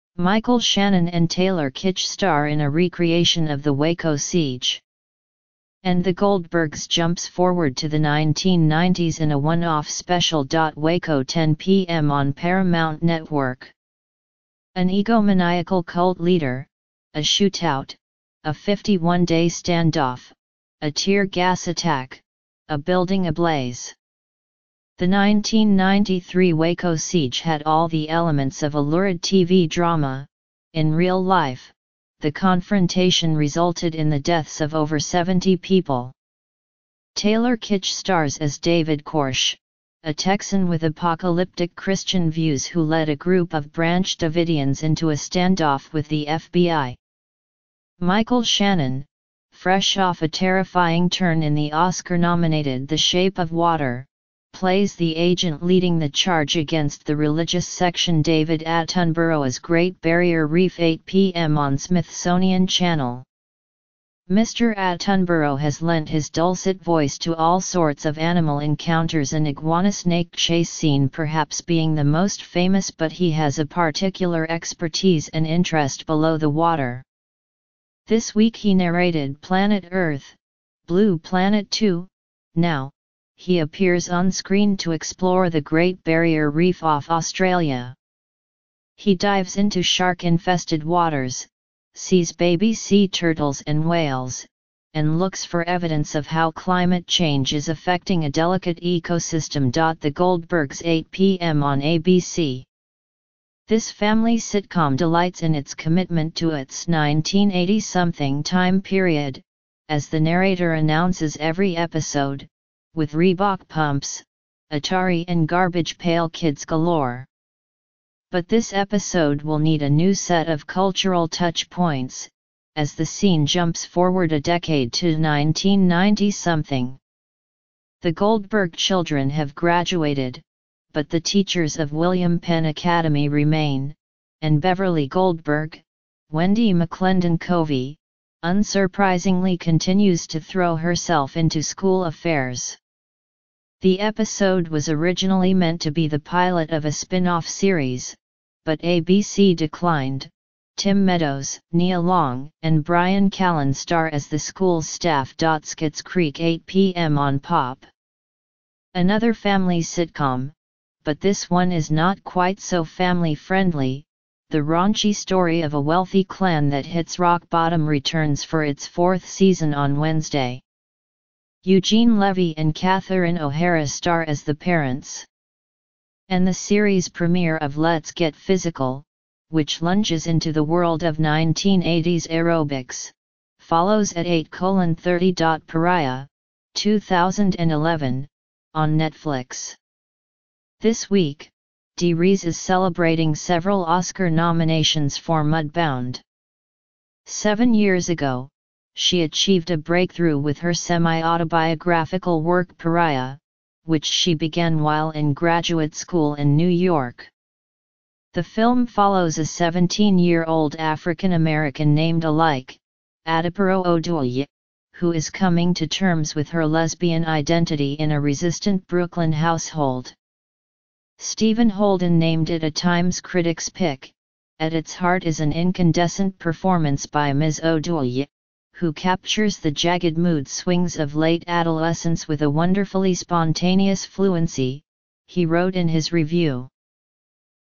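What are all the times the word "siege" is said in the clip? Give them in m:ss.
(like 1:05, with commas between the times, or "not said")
0:04, 0:26.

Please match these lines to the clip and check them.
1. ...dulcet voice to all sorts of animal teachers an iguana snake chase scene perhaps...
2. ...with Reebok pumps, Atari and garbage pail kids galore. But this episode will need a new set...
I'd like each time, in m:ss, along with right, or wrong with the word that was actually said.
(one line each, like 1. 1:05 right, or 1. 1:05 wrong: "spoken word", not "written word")
1. 1:06 wrong: "encounters", not "teachers"
2. 1:52 right.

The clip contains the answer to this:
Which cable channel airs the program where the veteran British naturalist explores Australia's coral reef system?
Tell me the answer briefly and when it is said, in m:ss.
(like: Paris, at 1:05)
Smithsonian Channel, at 1:01.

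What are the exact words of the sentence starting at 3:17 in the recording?
Seven years ago, she achieved a breakthrough with her semi-autobiographical work Pariah, which she began while in graduate school in New York.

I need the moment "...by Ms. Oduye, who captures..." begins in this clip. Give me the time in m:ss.
3:47.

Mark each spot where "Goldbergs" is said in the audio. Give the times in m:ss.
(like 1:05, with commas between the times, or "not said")
0:06, 1:40, 2:08, 2:15.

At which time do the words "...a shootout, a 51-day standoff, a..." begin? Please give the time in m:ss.
0:17.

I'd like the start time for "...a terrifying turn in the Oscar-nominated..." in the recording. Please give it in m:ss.
0:50.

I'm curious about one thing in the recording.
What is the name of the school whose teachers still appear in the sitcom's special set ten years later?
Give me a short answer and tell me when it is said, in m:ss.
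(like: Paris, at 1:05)
William Penn Academy, at 2:11.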